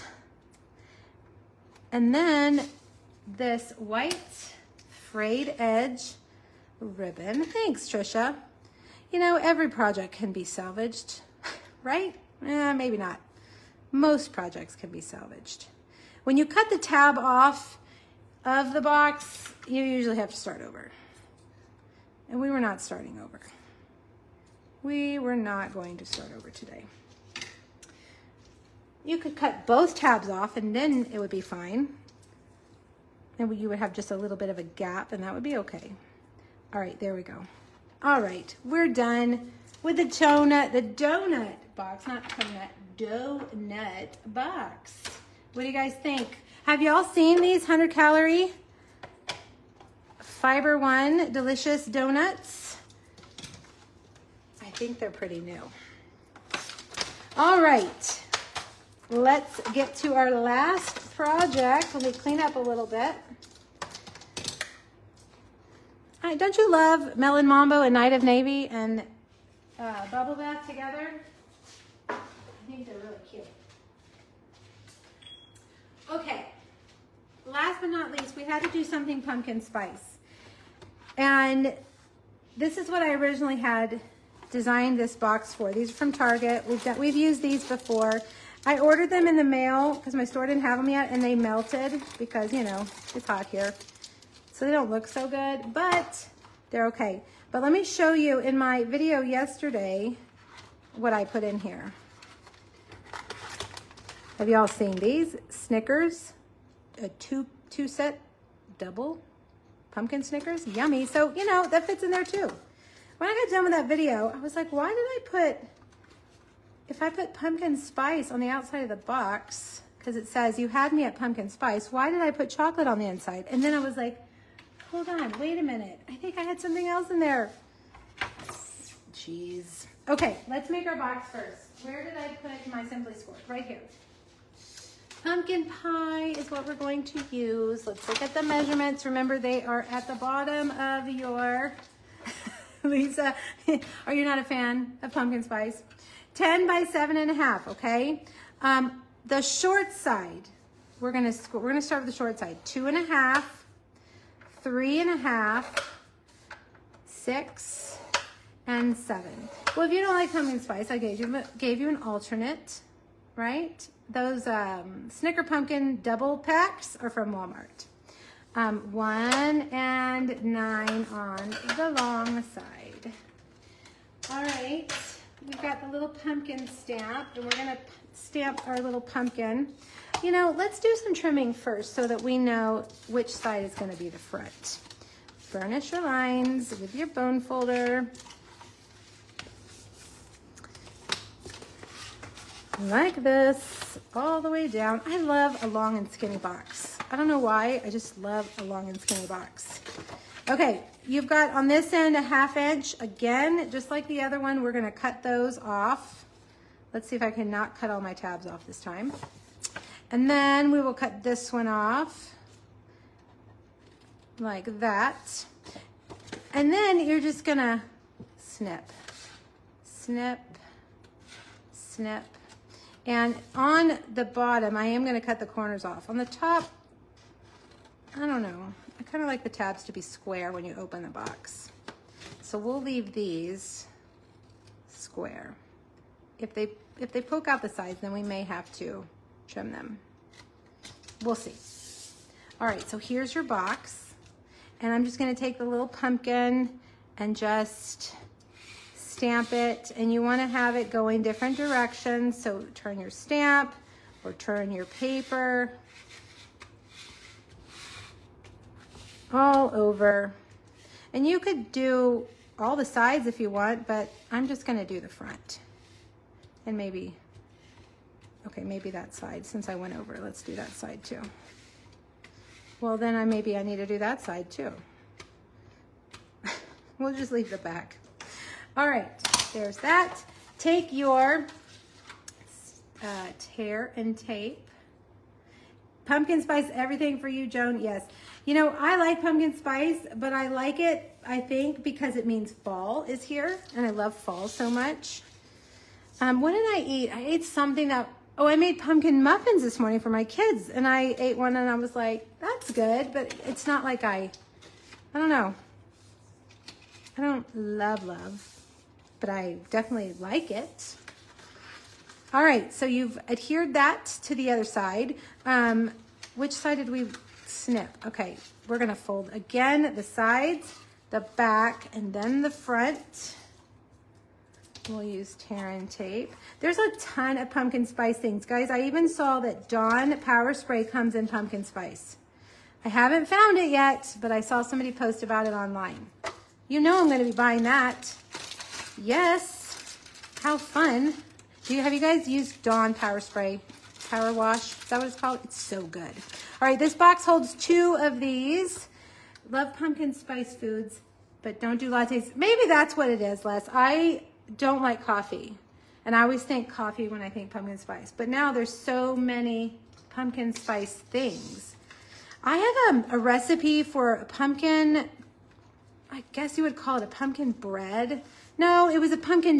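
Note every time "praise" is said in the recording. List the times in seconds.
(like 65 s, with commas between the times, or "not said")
not said.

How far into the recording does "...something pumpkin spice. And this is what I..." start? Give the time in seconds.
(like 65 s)
78 s.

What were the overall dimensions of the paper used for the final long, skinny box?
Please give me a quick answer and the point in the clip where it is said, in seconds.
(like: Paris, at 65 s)
10 by 7 1/2, at 146 s.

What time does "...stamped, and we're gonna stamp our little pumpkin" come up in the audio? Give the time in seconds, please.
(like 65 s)
176 s.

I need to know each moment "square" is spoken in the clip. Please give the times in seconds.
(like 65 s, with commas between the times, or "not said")
229 s, 234 s.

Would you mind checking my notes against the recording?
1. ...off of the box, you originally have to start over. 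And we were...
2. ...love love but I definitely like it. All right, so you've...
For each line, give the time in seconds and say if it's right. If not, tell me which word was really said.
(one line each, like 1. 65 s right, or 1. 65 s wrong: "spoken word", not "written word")
1. 17 s wrong: "usually", not "originally"
2. 307 s right.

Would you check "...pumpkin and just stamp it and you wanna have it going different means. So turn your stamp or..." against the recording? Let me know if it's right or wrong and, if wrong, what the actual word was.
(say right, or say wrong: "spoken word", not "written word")
wrong: "directions", not "means".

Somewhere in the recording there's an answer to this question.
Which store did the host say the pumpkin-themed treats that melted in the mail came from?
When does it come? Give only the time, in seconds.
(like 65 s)
86 s.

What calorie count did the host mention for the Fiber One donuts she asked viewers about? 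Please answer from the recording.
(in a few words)
100.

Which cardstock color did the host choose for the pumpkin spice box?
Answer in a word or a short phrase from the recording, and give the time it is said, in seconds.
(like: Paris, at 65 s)
Pumpkin pie, at 135 s.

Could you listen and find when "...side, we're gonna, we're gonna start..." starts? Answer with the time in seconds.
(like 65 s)
149 s.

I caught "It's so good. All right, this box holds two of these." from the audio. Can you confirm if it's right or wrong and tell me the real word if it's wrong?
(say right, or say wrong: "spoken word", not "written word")
right.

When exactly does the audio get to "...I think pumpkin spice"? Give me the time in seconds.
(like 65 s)
357 s.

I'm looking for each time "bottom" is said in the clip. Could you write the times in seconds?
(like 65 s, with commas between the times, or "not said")
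140 s, 224 s.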